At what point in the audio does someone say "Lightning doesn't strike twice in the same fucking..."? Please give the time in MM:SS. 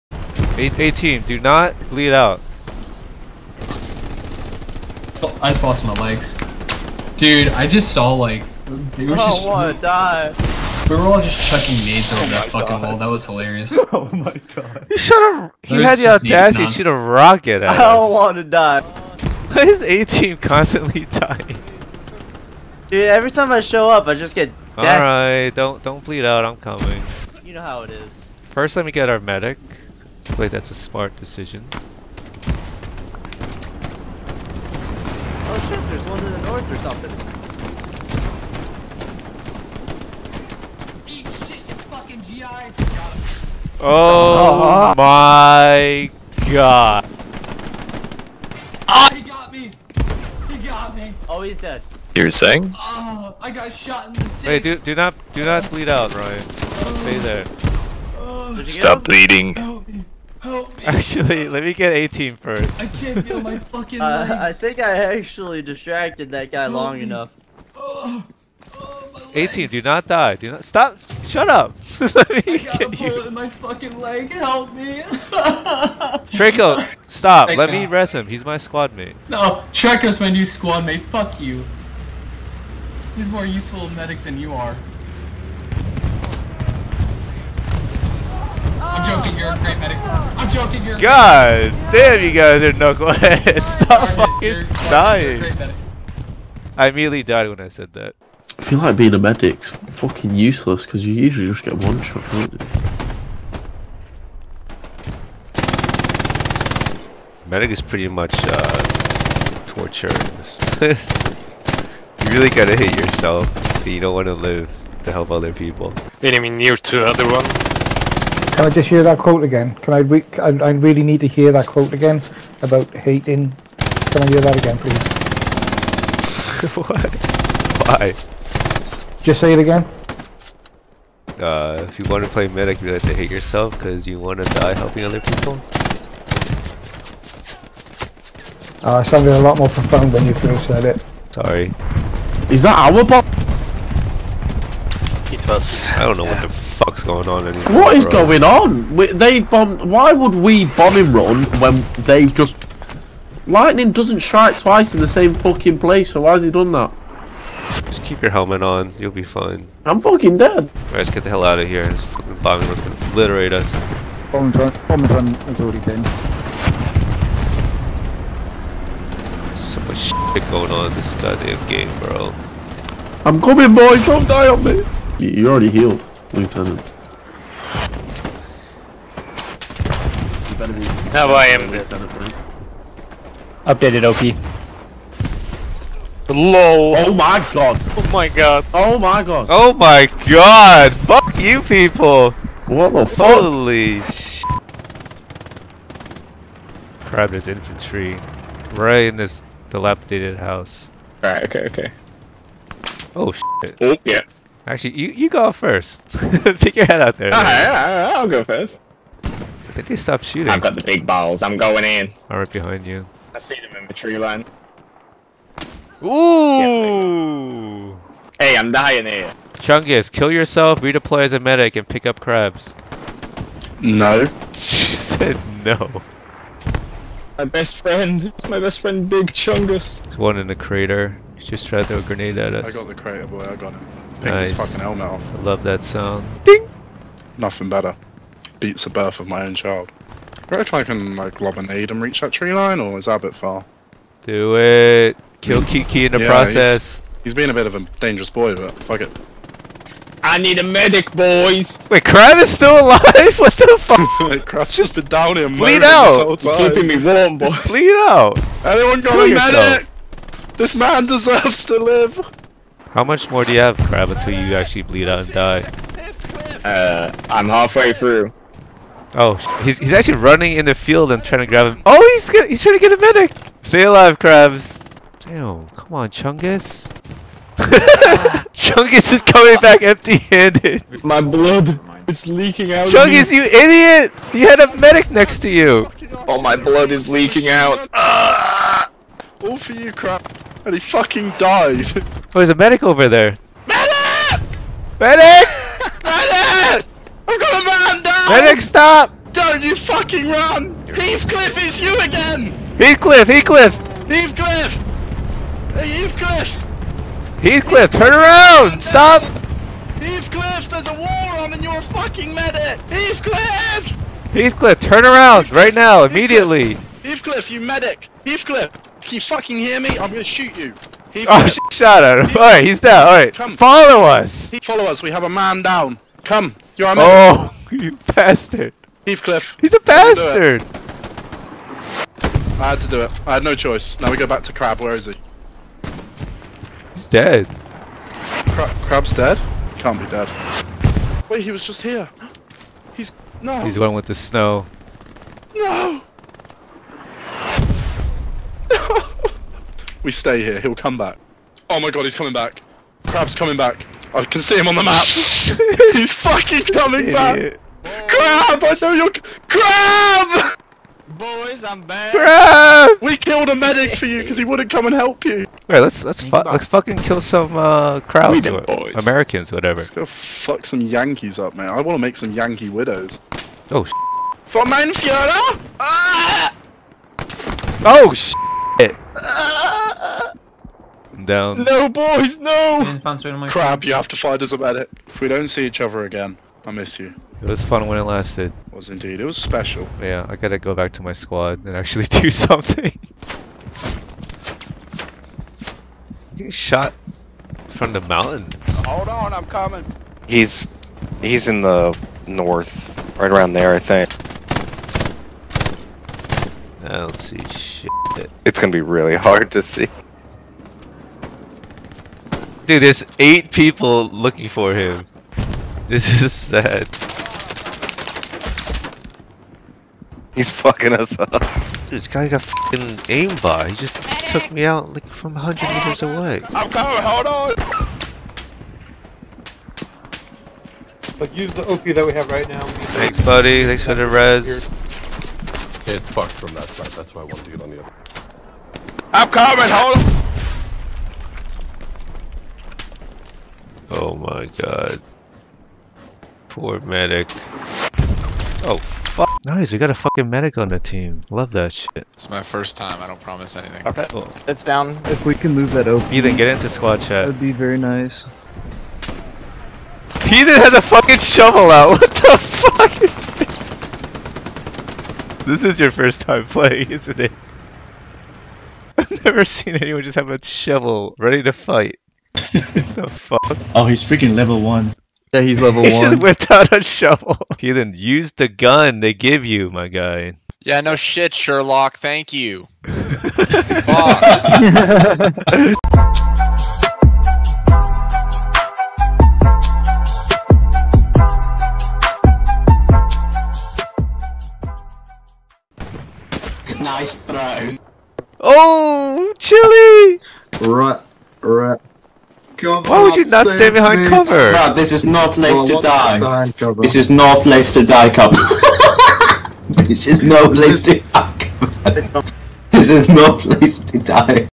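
02:33.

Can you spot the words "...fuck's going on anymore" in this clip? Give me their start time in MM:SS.
02:26.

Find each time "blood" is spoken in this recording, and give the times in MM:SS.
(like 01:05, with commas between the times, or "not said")
04:41, 04:46.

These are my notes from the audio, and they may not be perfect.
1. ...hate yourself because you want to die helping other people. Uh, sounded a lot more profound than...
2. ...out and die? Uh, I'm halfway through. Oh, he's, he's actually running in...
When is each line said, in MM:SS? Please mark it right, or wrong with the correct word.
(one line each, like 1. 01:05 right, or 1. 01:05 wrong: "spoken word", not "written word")
1. 02:13 right
2. 04:25 right.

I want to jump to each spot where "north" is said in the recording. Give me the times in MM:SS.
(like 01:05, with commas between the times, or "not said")
00:36, 06:42.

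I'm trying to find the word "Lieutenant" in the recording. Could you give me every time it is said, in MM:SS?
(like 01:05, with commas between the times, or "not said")
02:56.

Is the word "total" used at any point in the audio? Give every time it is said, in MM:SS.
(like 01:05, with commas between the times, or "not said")
not said.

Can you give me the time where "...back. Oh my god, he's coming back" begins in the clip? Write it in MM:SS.
05:50.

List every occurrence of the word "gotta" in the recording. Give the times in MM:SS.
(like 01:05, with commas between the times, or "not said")
01:52, 06:30.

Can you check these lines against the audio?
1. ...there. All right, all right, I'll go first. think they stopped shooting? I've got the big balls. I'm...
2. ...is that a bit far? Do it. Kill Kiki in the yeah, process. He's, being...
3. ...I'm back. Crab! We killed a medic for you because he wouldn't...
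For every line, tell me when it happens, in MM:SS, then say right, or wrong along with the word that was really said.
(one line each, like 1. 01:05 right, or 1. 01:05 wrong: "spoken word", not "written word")
1. 03:27 right
2. 04:02 right
3. 06:01 right.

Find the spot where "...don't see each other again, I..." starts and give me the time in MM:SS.
06:25.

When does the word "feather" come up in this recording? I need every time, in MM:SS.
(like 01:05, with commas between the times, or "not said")
not said.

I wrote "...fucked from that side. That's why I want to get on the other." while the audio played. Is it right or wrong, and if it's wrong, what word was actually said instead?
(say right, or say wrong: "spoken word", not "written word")
right.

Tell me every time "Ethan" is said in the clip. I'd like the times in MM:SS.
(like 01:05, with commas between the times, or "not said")
07:36, 07:40.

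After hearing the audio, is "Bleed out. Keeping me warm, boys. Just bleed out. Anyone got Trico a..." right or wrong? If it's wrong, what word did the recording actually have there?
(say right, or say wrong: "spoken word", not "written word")
wrong: "Kill", not "Trico".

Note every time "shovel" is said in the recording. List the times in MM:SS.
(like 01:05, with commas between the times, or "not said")
07:41, 07:50, 07:56.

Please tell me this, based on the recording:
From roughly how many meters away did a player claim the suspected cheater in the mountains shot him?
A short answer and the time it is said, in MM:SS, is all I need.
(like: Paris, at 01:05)
100, at 07:05.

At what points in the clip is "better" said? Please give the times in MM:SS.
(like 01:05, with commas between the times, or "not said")
03:00, 03:57.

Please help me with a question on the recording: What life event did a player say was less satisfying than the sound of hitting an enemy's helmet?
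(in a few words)
birth of my own child.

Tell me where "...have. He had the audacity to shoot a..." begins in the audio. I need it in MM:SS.
00:15.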